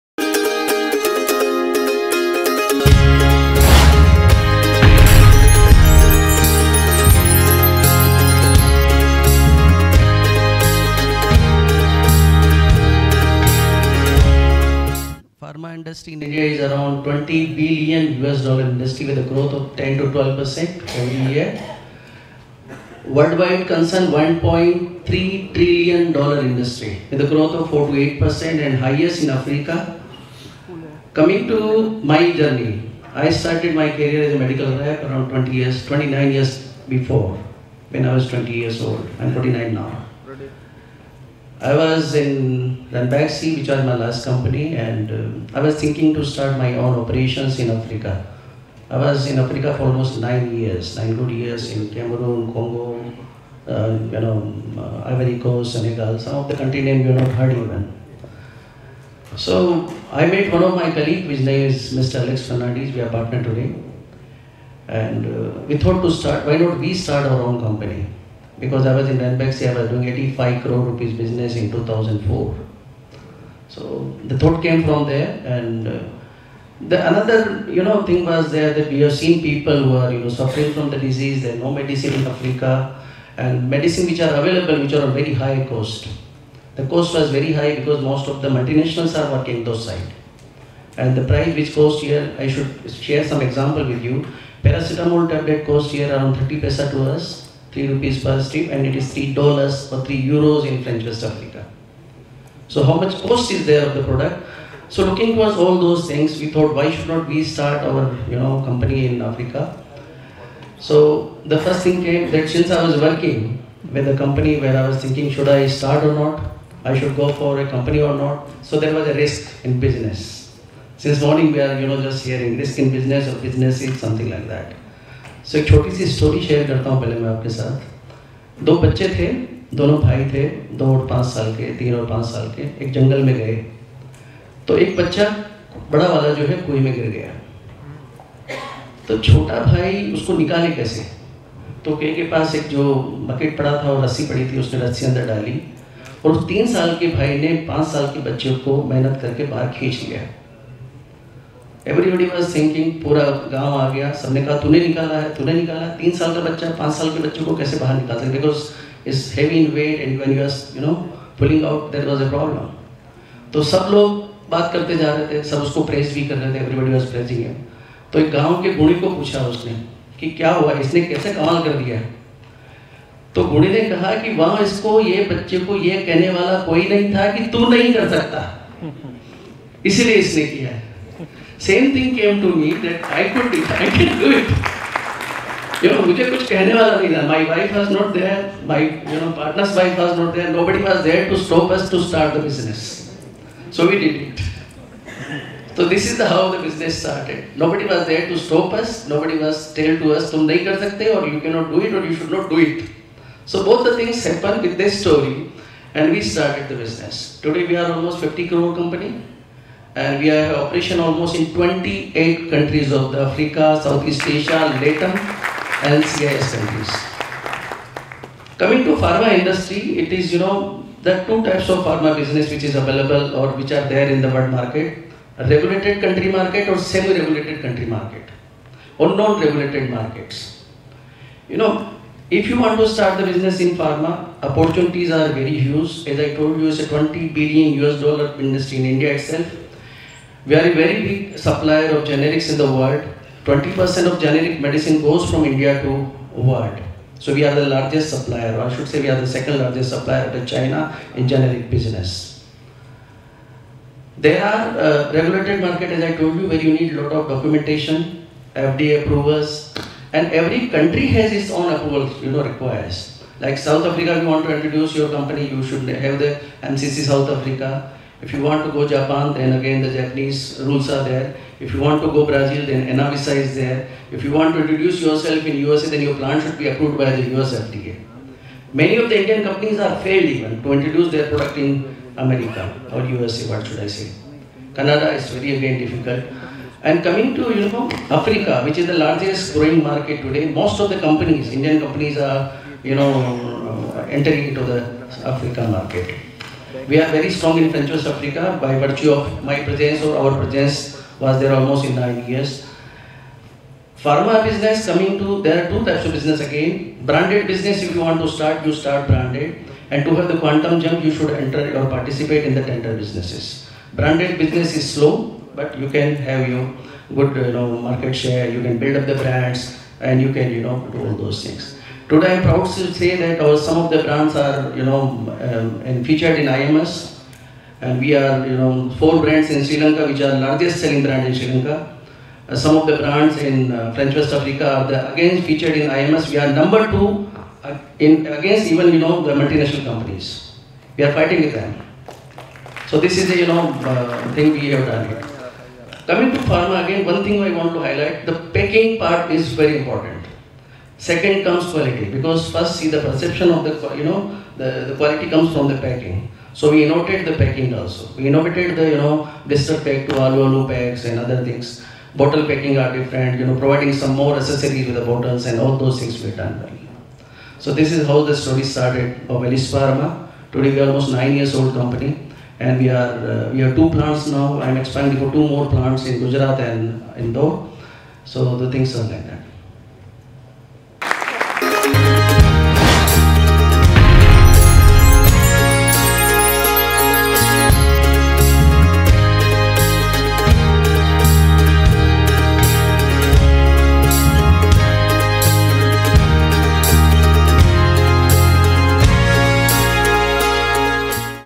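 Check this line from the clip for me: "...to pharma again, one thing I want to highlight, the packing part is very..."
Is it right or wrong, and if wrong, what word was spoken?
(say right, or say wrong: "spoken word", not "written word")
right.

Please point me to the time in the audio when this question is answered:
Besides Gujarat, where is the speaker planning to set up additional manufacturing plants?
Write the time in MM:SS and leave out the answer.
06:17.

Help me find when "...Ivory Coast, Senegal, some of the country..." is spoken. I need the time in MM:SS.
00:55.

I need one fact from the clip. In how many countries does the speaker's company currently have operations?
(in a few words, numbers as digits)
28.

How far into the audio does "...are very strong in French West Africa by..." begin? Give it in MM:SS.
04:57.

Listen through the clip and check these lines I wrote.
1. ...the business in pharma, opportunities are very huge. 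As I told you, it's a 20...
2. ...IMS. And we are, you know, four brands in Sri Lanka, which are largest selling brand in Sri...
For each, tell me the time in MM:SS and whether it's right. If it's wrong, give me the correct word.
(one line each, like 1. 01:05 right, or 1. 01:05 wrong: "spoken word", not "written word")
1. 03:53 right
2. 05:26 right.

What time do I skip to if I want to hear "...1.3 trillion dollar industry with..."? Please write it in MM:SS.
00:24.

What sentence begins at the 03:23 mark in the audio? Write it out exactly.
So both the things happened with this story, and we started the business.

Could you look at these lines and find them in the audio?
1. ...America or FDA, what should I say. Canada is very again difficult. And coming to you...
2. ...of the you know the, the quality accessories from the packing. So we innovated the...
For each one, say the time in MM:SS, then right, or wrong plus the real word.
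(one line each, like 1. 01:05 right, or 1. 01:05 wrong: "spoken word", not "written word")
1. 04:42 wrong: "USA", not "FDA"
2. 05:53 wrong: "comes", not "accessories".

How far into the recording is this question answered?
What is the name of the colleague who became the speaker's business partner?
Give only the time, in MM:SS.
01:02.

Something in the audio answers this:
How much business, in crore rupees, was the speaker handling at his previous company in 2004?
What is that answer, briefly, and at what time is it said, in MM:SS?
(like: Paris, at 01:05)
85 crore rupees, at 01:10.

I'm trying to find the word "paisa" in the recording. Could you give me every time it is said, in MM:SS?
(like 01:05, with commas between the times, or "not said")
01:36.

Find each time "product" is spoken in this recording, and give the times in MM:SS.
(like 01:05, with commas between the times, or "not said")
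01:44, 04:41.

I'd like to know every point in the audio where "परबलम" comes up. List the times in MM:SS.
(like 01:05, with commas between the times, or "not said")
02:42.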